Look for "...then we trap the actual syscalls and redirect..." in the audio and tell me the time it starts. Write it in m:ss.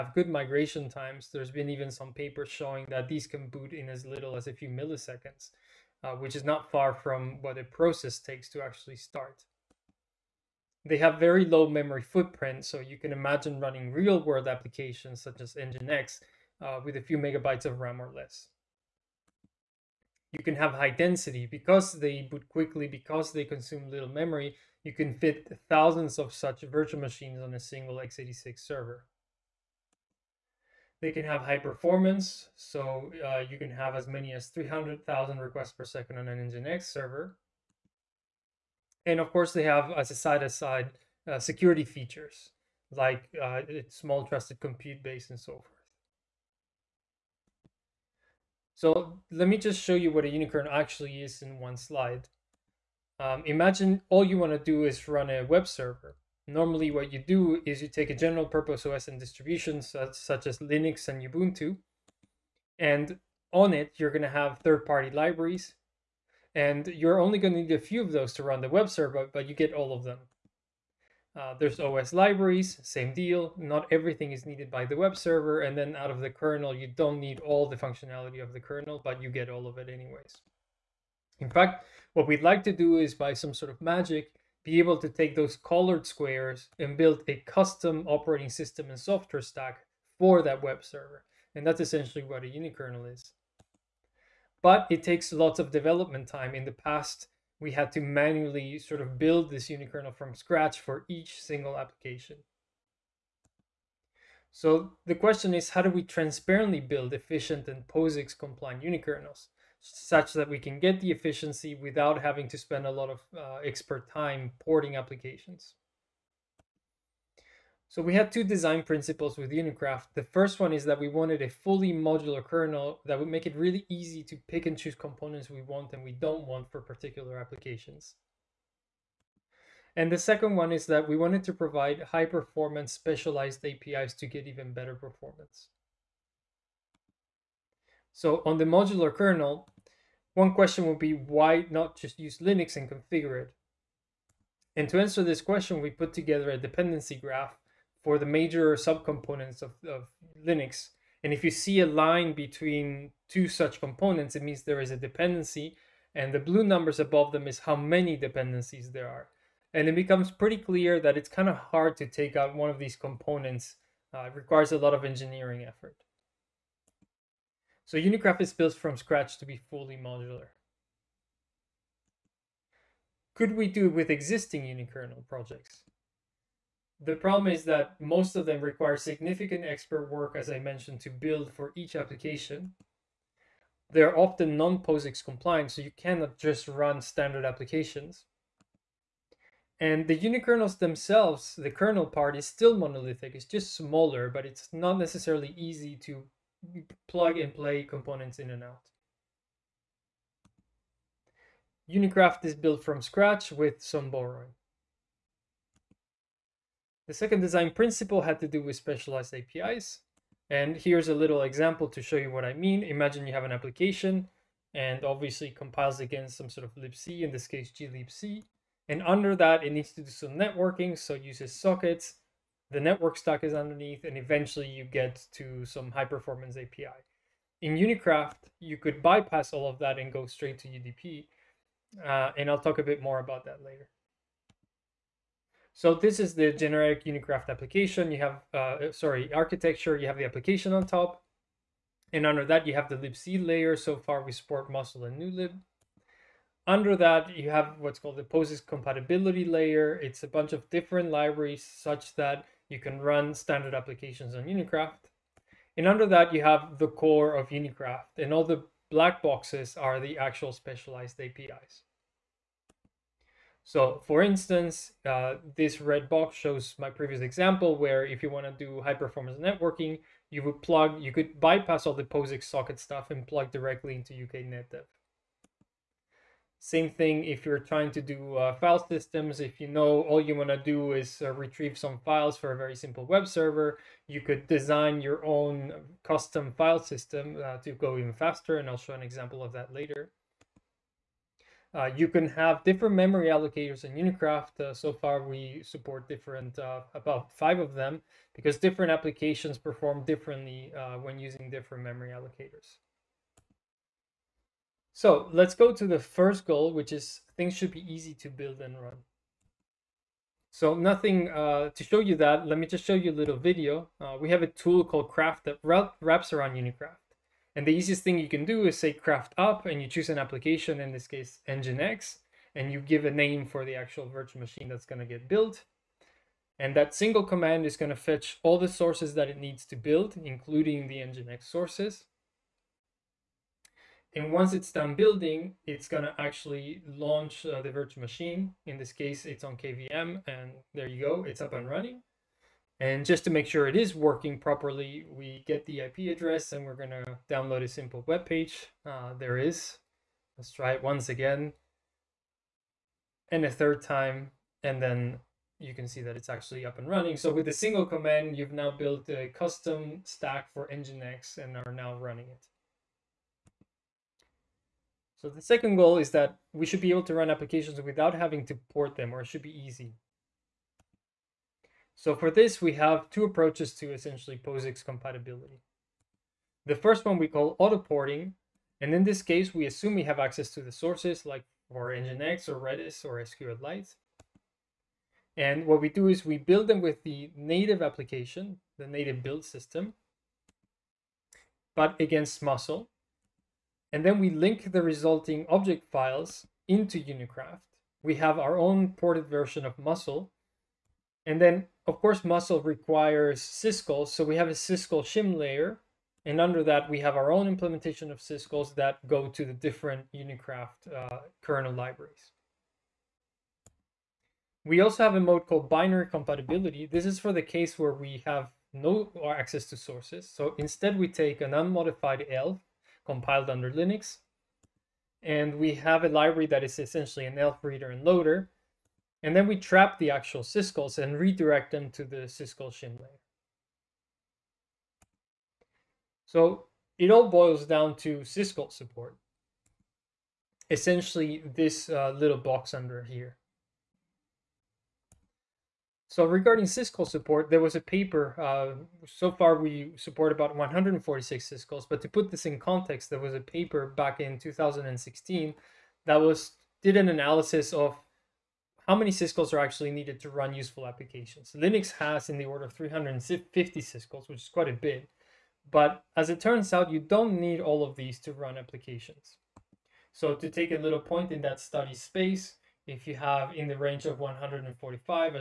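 7:09.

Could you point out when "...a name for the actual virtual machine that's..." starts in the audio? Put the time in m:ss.
5:23.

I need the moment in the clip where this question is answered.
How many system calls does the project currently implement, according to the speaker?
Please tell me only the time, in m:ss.
7:30.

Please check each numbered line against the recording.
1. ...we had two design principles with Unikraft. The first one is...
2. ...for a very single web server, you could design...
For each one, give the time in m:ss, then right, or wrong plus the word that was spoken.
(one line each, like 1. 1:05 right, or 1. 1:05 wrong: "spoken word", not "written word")
1. 1:58 right
2. 4:42 wrong: "simple", not "single".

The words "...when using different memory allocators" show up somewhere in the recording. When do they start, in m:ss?
5:00.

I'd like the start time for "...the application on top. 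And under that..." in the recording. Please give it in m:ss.
4:00.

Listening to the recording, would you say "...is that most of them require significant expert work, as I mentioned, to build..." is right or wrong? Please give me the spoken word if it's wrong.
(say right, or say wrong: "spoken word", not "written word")
right.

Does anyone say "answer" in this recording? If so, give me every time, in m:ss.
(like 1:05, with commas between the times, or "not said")
2:24.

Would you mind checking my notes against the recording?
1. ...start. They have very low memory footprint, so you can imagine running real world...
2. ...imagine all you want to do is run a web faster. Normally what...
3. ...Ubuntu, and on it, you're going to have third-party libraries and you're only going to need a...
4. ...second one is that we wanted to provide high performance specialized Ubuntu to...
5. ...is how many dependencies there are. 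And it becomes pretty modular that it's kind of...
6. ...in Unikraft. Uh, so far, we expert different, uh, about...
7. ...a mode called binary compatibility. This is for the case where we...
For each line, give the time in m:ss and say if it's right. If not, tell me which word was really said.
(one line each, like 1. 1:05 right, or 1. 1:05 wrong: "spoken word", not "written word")
1. 0:08 right
2. 0:53 wrong: "server", not "faster"
3. 1:01 right
4. 2:10 wrong: "APIs", not "Ubuntu"
5. 2:37 wrong: "clear", not "modular"
6. 4:53 wrong: "support", not "expert"
7. 6:55 right.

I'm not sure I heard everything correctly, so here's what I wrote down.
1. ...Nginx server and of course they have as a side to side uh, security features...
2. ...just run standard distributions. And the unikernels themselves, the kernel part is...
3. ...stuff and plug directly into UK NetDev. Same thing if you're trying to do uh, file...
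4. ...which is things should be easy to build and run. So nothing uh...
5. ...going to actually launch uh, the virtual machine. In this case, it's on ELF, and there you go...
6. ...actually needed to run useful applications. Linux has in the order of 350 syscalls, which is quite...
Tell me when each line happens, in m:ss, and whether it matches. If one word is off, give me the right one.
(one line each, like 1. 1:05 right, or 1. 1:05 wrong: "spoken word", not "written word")
1. 0:36 right
2. 3:06 wrong: "applications", not "distributions"
3. 4:32 right
4. 5:06 right
5. 5:35 wrong: "KVM", not "ELF"
6. 7:39 right.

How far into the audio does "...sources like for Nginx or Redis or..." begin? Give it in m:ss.
6:20.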